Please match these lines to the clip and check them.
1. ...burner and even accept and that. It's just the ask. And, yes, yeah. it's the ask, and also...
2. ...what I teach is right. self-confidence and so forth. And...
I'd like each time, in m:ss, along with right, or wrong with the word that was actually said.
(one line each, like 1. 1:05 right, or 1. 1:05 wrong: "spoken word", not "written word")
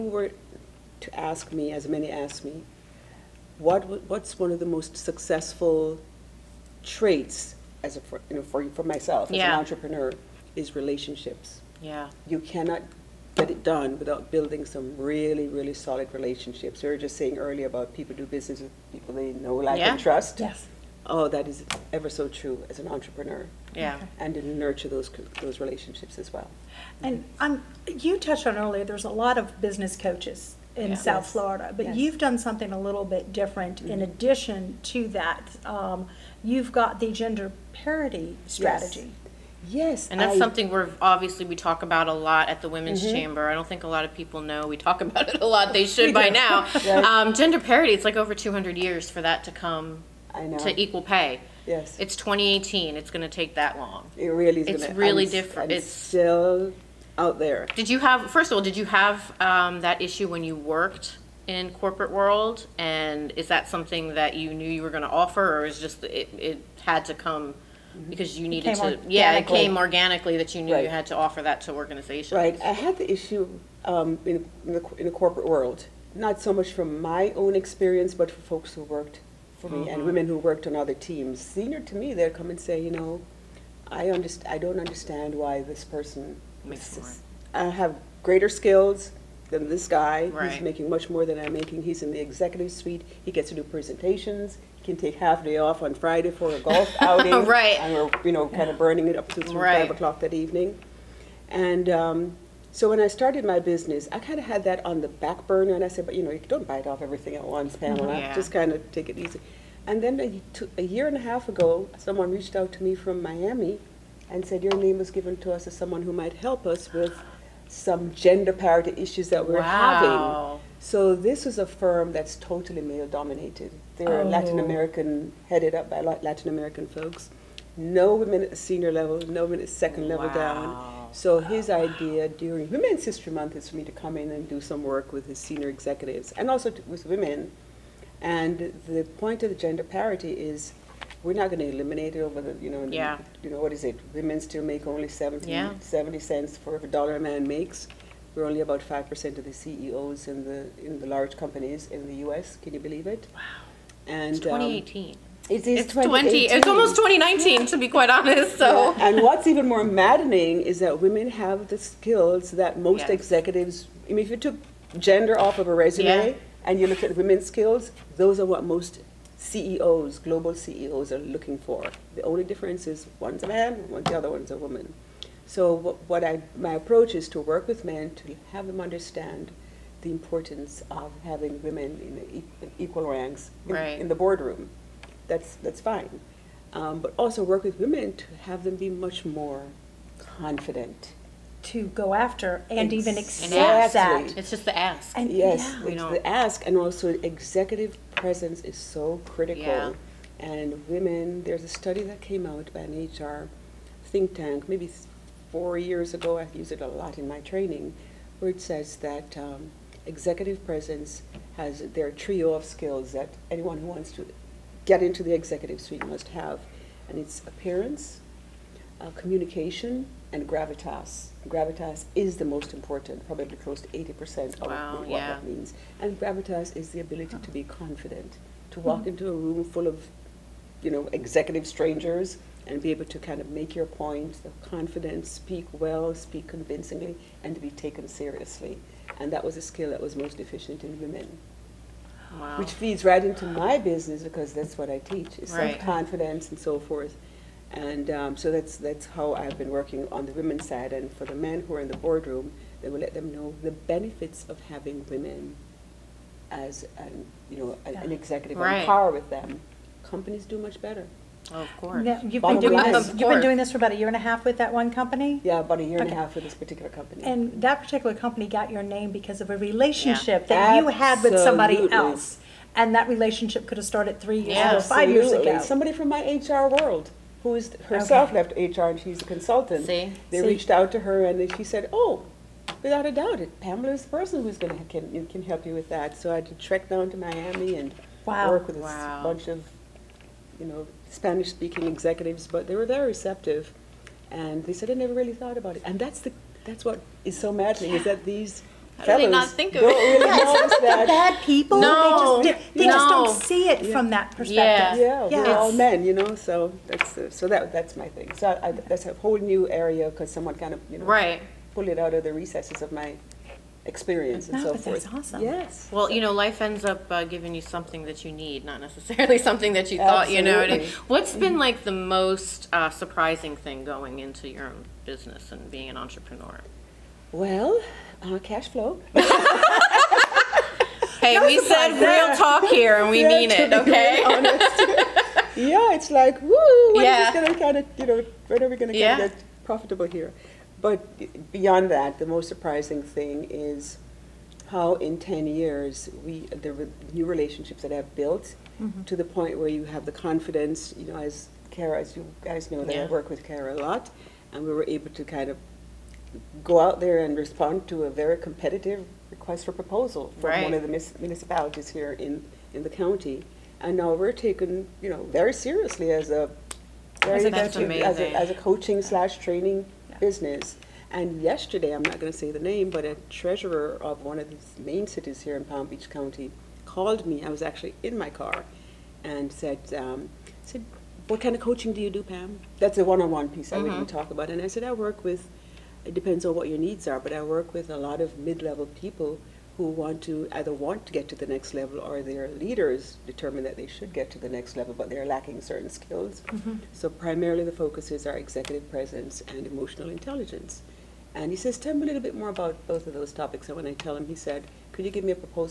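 1. 3:12 wrong: "after", not "burner"
2. 4:04 right.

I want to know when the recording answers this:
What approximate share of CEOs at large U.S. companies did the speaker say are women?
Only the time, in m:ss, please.
2:28.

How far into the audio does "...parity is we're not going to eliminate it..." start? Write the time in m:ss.
2:19.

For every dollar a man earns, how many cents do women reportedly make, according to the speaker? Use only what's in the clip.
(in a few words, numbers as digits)
70 cents.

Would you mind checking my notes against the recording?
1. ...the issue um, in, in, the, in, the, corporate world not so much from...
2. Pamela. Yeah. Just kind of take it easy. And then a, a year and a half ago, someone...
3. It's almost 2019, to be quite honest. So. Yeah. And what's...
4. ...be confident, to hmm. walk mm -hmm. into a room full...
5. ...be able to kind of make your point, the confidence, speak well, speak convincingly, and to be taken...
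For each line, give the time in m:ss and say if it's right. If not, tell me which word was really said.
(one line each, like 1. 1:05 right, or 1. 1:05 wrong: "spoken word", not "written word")
1. 1:12 right
2. 1:47 right
3. 2:36 right
4. 3:47 right
5. 3:52 right.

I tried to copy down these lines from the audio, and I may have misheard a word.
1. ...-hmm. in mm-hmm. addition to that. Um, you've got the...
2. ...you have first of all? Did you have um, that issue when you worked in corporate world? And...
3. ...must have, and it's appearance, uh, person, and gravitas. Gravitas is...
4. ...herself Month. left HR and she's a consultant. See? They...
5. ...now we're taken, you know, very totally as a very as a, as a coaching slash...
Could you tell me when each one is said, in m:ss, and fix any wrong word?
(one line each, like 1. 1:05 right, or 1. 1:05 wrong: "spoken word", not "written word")
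1. 0:33 right
2. 0:57 right
3. 3:36 wrong: "communication", not "person"
4. 4:37 wrong: "Okay", not "Month"
5. 6:04 wrong: "seriously", not "totally".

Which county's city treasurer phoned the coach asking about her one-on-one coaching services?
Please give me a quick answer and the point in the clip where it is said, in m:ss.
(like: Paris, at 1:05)
Palm Beach County, at 6:15.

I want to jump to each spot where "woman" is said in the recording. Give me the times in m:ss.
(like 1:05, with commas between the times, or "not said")
2:54.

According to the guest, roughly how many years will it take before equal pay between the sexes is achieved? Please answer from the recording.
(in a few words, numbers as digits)
over 200 years.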